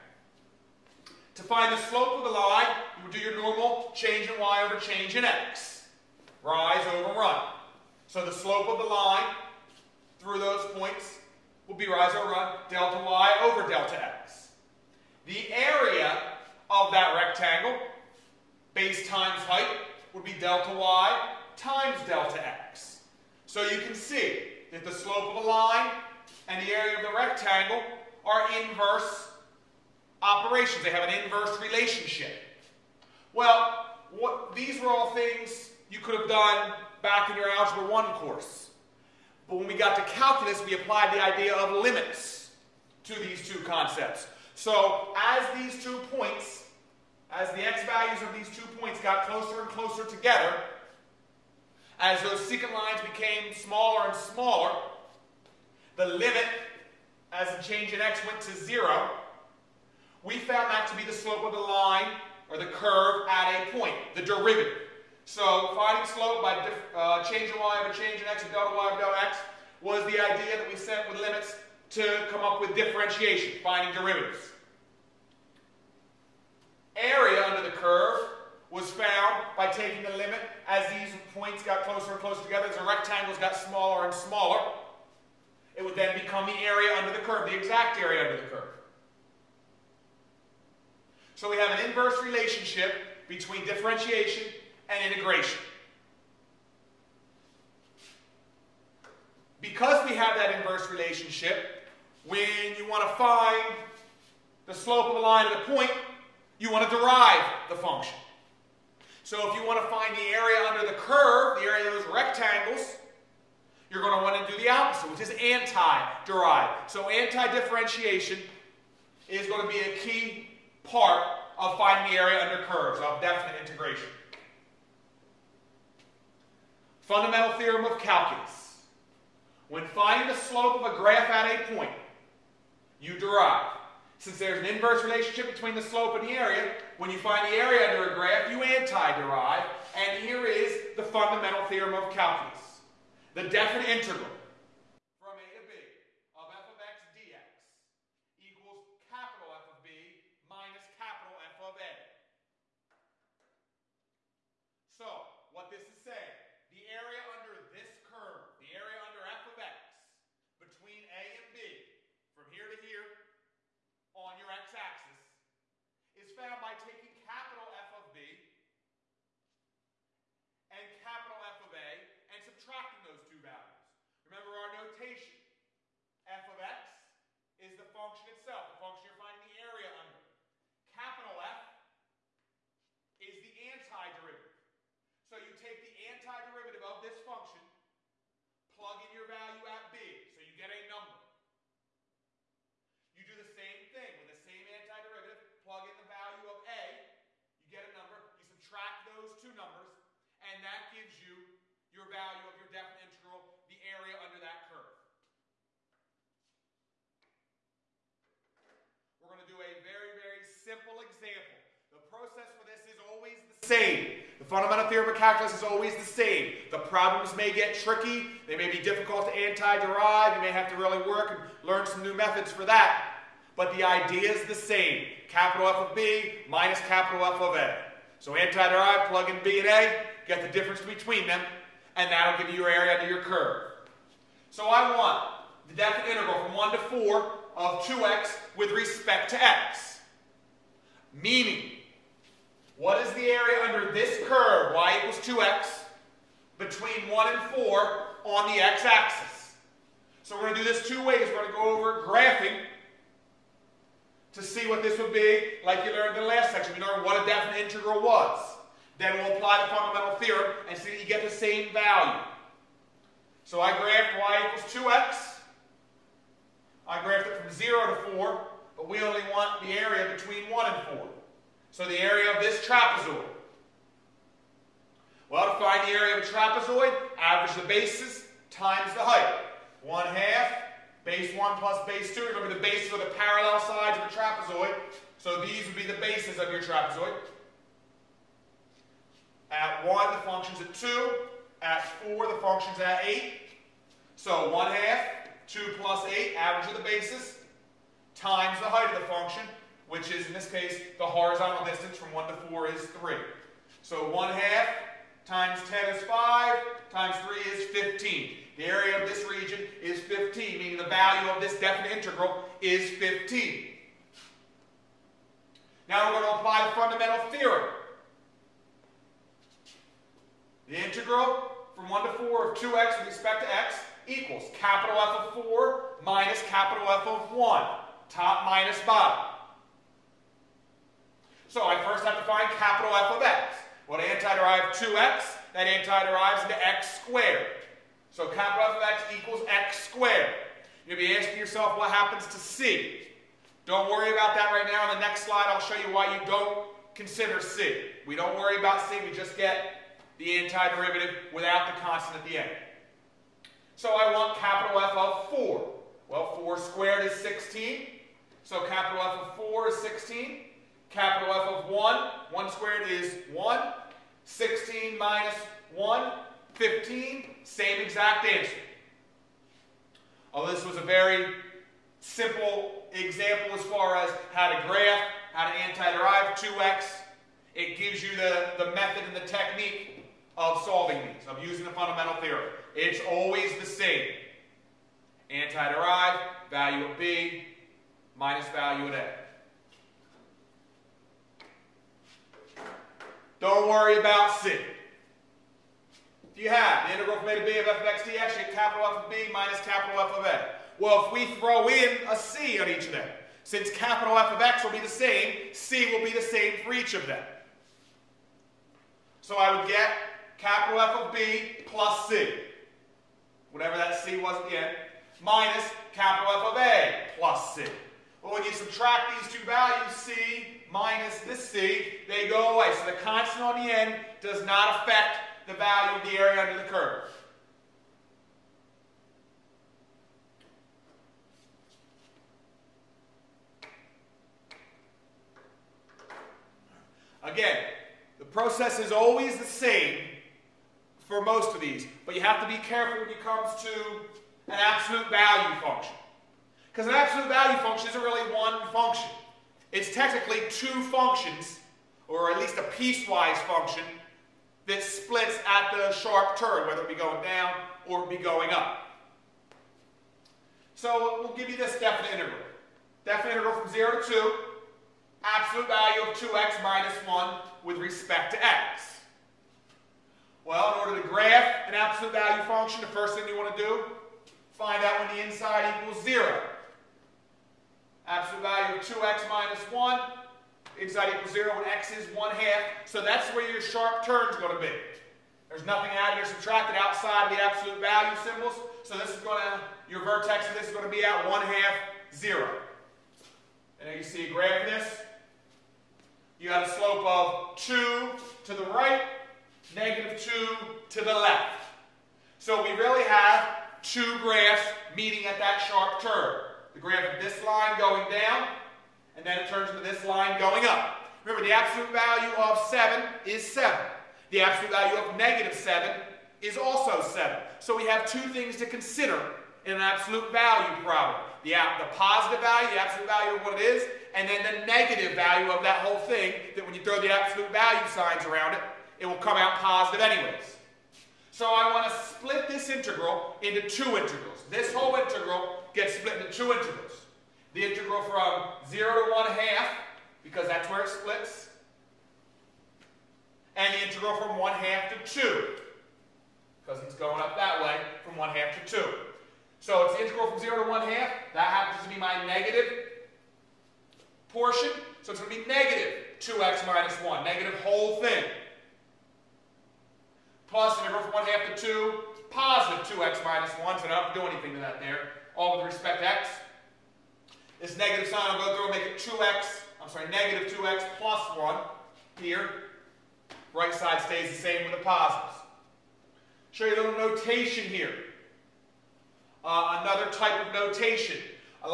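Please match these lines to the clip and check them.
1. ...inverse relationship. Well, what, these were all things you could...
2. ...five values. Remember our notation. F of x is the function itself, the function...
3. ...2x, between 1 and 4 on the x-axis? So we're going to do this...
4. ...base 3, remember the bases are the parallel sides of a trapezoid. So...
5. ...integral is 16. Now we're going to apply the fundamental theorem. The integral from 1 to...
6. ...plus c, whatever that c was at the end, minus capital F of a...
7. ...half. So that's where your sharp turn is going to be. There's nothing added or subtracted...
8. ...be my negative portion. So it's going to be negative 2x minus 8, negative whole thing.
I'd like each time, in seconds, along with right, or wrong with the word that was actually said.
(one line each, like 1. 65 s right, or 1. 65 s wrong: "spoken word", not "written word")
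1. 31 s right
2. 173 s wrong: "two", not "five"
3. 245 s right
4. 281 s wrong: "2", not "3"
5. 311 s wrong: "15", not "16"
6. 411 s right
7. 482 s right
8. 551 s wrong: "1", not "8".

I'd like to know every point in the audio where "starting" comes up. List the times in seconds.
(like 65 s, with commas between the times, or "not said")
not said.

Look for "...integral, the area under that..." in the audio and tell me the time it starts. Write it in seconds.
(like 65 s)
203 s.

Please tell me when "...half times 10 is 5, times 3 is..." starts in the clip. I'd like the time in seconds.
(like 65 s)
304 s.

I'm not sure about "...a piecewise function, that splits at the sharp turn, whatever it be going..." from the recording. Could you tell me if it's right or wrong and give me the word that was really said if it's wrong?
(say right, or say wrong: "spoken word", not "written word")
wrong: "whether", not "whatever".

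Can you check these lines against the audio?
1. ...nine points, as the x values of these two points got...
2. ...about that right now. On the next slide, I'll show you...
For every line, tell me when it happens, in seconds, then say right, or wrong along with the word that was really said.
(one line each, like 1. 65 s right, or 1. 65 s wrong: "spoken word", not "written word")
1. 45 s wrong: "two", not "nine"
2. 344 s right.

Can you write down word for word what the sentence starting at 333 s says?
Well, to antiderive 2x, that antiderives into x squared.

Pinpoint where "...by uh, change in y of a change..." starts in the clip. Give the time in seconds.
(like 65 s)
66 s.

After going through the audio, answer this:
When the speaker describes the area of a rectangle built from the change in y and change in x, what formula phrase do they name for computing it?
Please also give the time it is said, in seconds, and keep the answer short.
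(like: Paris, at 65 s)
Base times height, at 18 s.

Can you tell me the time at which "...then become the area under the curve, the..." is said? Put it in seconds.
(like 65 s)
85 s.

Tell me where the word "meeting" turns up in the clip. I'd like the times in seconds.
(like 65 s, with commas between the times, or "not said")
504 s.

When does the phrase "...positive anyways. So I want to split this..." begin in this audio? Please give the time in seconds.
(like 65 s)
529 s.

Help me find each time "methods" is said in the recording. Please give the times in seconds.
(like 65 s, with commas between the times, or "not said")
222 s, 378 s.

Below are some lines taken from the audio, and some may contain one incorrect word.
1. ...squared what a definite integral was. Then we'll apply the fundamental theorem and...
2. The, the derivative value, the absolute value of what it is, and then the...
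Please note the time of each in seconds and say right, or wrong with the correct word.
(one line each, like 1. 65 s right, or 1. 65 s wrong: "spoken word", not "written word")
1. 256 s wrong: "learned", not "squared"
2. 521 s wrong: "positive", not "derivative".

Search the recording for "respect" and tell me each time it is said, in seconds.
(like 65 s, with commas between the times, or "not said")
238 s, 323 s, 467 s, 565 s.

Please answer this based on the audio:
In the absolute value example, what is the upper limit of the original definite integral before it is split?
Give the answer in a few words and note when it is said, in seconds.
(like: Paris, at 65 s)
2, at 463 s.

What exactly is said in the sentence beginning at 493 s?
And you see a graph of this.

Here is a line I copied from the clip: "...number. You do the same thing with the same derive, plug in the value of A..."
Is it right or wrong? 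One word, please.
wrong.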